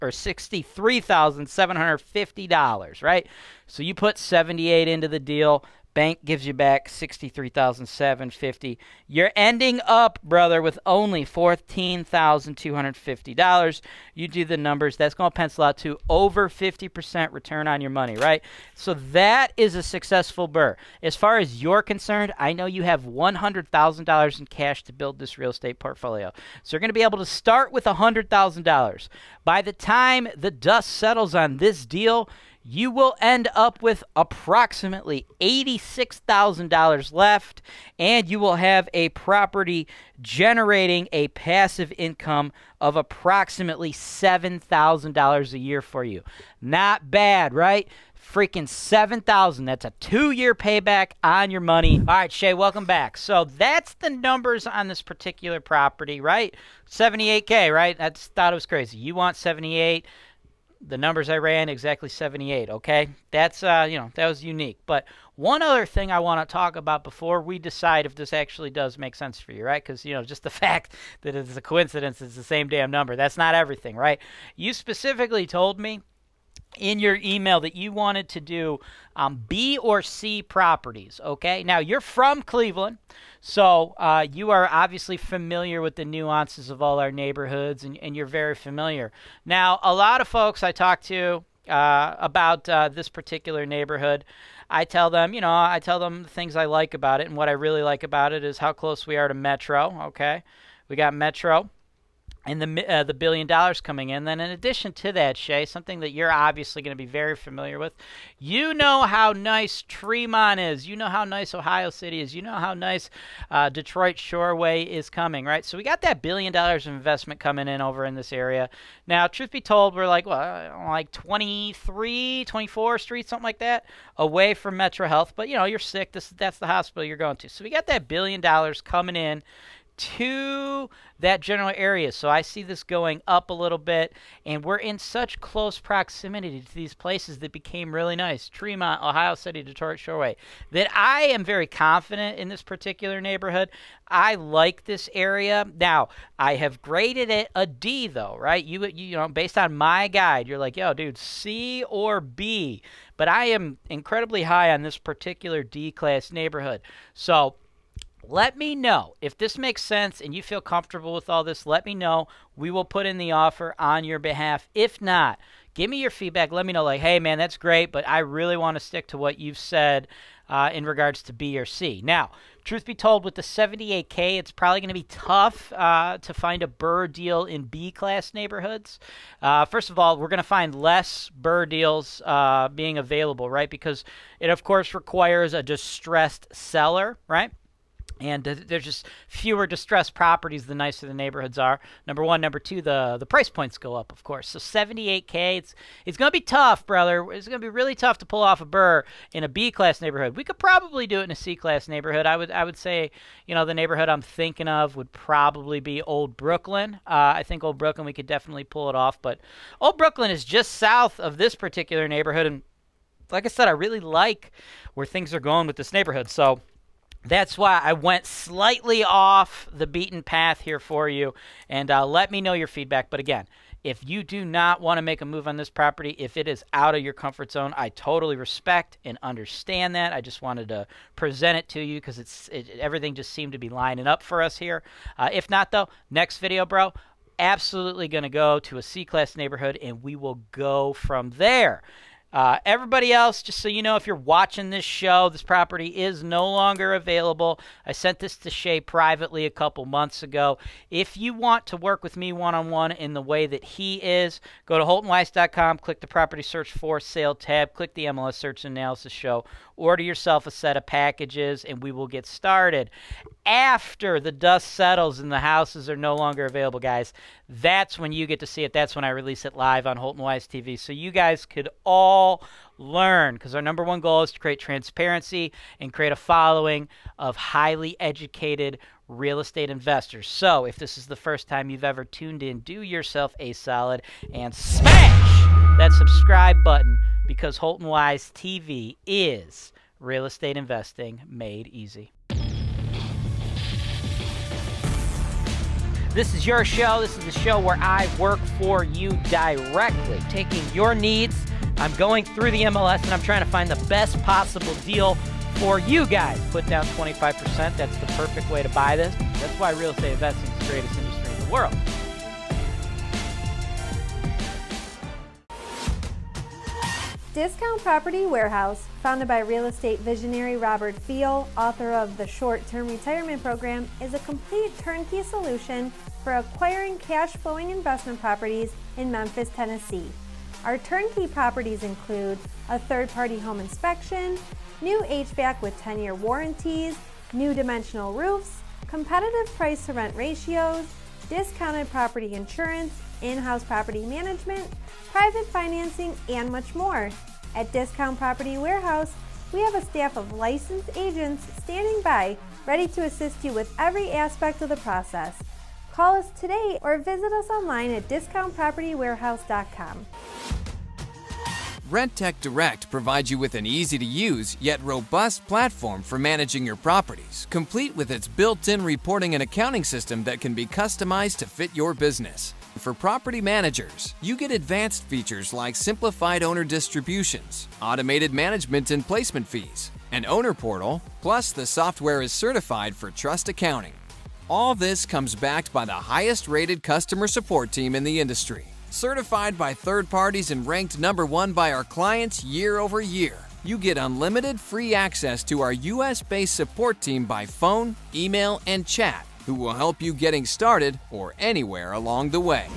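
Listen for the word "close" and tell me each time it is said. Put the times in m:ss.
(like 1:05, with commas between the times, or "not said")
1:38, 2:15.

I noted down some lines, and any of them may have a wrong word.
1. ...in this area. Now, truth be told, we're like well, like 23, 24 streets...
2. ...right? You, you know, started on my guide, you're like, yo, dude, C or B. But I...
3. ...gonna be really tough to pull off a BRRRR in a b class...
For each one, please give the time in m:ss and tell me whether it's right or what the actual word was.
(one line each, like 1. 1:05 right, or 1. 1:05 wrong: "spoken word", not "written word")
1. 1:58 right
2. 2:28 wrong: "based", not "started"
3. 3:17 right.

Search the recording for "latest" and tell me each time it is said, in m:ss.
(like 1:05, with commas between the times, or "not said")
not said.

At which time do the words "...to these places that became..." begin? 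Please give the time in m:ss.
2:16.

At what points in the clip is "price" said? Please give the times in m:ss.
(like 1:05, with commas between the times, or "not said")
3:13, 5:39.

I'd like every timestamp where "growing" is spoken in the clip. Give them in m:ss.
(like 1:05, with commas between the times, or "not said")
not said.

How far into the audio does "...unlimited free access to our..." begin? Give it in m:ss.
6:33.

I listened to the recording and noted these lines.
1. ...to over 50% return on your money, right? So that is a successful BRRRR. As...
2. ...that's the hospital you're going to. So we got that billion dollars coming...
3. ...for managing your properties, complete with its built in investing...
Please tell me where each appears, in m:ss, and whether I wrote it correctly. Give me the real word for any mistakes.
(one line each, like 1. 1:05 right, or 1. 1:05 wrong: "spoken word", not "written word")
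1. 0:15 right
2. 2:06 right
3. 6:06 wrong: "reporting", not "investing".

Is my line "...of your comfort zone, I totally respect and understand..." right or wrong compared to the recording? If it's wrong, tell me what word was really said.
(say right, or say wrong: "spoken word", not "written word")
right.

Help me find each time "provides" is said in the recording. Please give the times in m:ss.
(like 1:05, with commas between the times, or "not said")
6:02.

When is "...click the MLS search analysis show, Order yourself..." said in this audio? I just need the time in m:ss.
4:17.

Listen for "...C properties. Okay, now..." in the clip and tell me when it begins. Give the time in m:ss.
1:20.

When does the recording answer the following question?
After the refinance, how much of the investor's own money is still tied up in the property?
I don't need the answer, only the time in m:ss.
0:11.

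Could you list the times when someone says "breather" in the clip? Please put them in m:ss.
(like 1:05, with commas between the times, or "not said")
not said.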